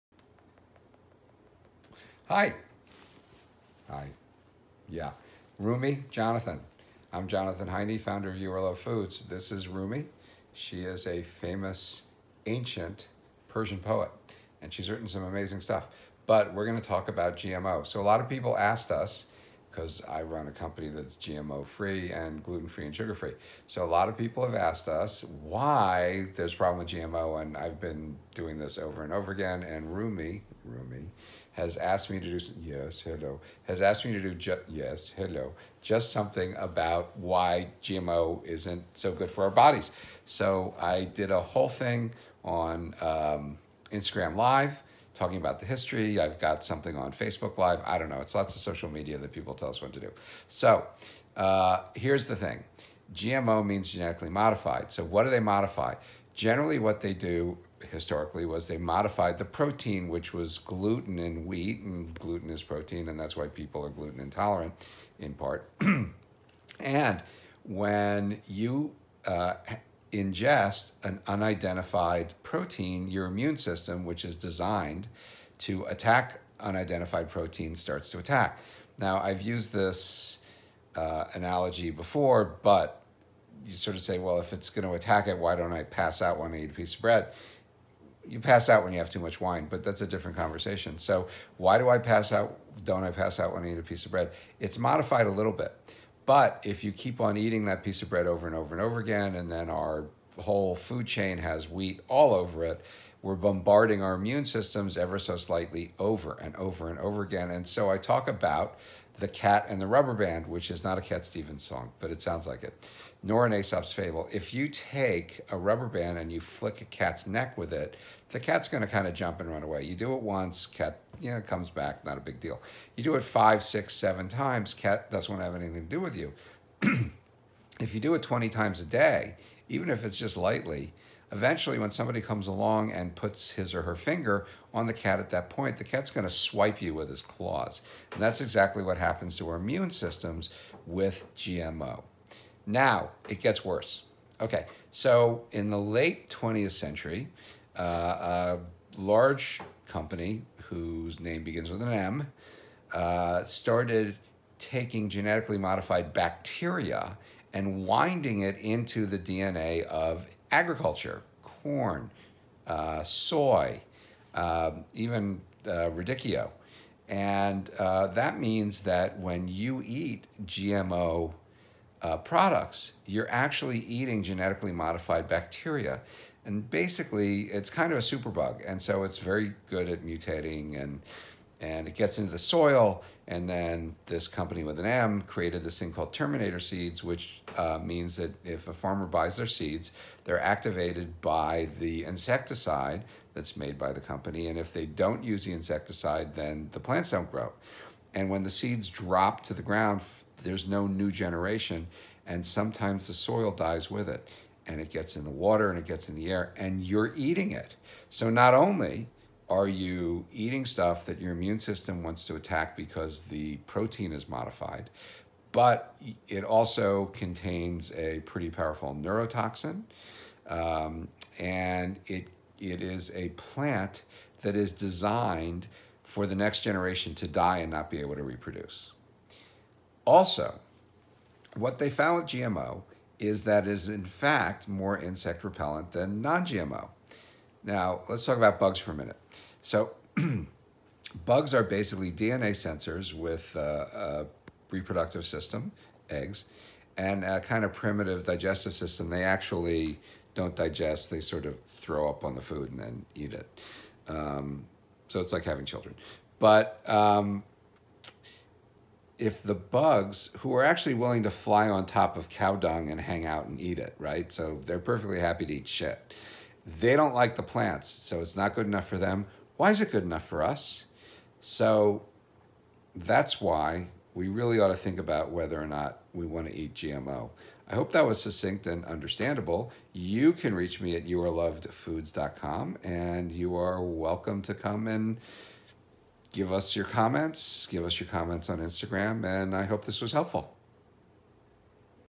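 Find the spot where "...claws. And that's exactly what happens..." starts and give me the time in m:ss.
2:17.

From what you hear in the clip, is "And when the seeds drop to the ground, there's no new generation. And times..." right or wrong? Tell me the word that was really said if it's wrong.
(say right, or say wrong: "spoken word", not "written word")
wrong: "sometimes", not "times".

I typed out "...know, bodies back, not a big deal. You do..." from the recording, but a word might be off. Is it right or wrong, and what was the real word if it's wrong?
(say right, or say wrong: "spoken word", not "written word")
wrong: "comes", not "bodies".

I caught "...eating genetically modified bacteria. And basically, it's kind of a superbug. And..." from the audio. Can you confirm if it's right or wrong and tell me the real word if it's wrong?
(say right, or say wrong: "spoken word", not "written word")
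right.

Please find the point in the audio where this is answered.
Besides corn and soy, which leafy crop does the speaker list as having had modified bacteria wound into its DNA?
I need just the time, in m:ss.
2:45.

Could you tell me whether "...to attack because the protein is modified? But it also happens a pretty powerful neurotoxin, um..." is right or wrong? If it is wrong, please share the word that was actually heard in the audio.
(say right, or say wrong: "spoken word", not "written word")
wrong: "contains", not "happens".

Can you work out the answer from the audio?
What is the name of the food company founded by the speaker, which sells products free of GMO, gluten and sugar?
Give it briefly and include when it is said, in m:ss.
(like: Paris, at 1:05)
You Are Loved Foods, at 0:08.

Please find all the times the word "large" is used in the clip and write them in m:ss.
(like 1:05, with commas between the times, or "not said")
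2:28.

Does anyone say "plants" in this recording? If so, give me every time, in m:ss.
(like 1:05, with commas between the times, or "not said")
3:16, 3:43, 4:27.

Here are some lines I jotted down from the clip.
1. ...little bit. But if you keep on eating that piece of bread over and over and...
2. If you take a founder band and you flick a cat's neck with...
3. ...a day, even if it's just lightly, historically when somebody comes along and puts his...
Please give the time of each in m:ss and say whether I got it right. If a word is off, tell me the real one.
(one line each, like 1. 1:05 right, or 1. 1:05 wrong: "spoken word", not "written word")
1. 1:35 right
2. 1:54 wrong: "rubber", not "founder"
3. 2:08 wrong: "eventually", not "historically".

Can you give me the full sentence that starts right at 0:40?
So I did a whole thing on um, Instagram Live talking about the history.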